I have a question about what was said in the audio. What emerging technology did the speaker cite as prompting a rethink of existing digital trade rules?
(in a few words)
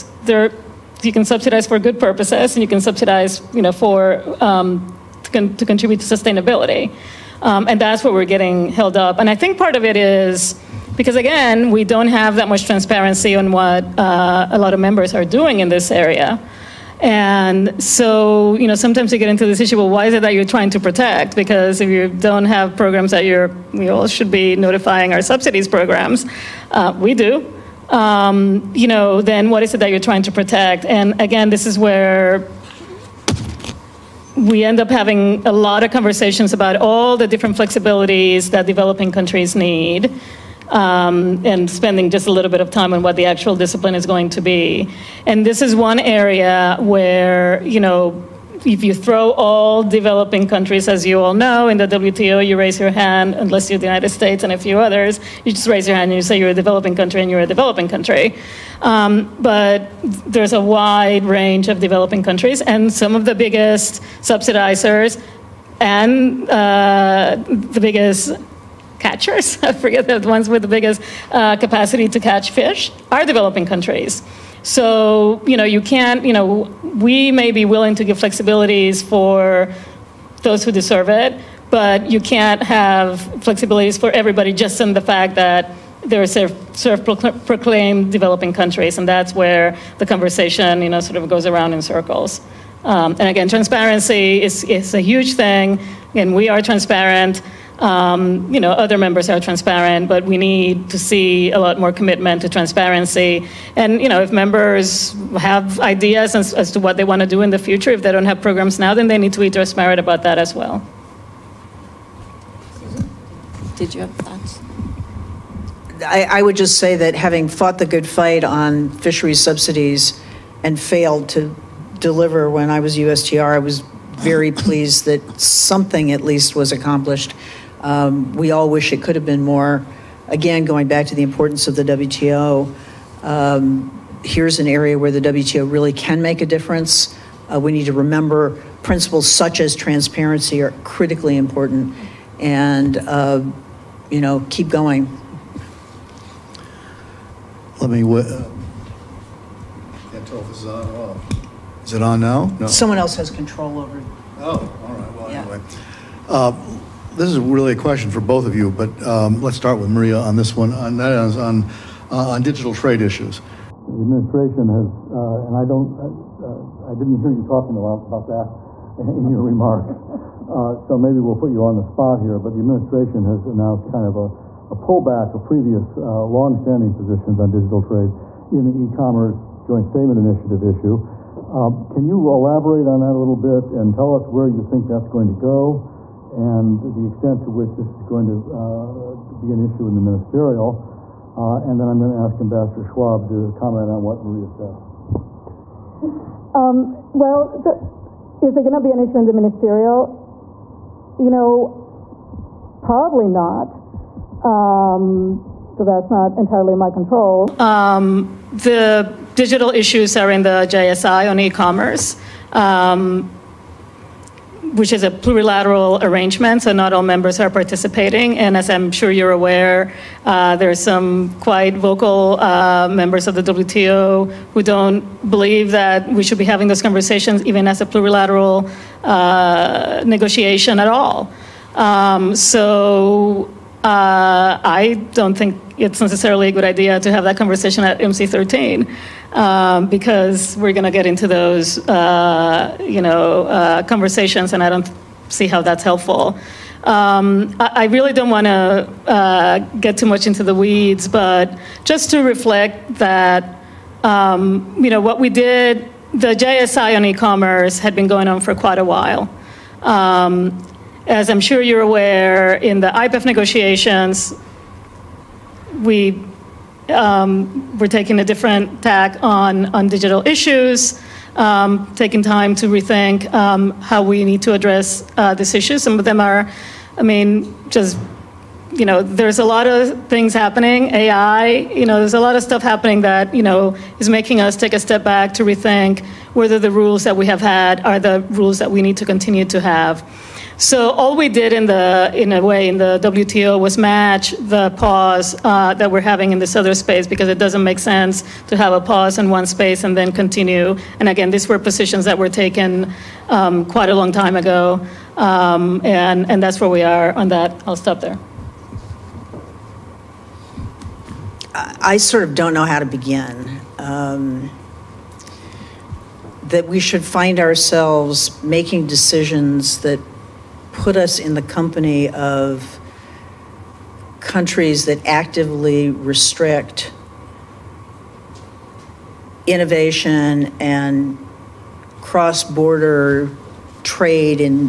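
AI.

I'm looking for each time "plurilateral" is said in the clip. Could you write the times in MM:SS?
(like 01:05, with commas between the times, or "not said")
03:35, 03:47.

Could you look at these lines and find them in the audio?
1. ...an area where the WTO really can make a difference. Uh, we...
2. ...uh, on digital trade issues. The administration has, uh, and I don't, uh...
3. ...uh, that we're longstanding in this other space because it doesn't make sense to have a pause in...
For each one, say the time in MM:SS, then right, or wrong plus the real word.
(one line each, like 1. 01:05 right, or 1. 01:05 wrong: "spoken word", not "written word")
1. 02:14 right
2. 02:41 right
3. 04:55 wrong: "having", not "longstanding".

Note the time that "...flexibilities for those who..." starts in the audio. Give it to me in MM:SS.
01:18.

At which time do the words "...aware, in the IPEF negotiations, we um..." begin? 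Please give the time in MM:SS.
04:21.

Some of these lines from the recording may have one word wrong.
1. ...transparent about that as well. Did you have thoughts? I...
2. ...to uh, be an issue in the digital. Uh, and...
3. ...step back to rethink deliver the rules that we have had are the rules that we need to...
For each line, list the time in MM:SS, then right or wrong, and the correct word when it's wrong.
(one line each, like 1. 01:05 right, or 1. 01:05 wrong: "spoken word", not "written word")
1. 01:49 right
2. 03:08 wrong: "ministerial", not "digital"
3. 04:44 wrong: "whether", not "deliver".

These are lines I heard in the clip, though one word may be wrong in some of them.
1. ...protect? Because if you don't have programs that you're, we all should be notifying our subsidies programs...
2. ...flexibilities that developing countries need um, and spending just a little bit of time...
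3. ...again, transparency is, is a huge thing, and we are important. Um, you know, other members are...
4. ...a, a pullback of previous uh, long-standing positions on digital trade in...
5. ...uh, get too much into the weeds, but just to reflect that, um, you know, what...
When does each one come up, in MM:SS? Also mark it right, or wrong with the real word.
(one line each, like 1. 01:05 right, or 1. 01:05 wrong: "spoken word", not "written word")
1. 00:20 right
2. 00:37 right
3. 01:33 wrong: "transparent", not "important"
4. 02:54 right
5. 04:09 right.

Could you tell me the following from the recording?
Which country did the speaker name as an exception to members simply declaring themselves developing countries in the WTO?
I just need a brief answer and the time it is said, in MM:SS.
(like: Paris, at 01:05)
United States, at 00:53.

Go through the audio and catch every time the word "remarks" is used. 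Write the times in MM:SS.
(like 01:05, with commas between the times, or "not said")
02:49.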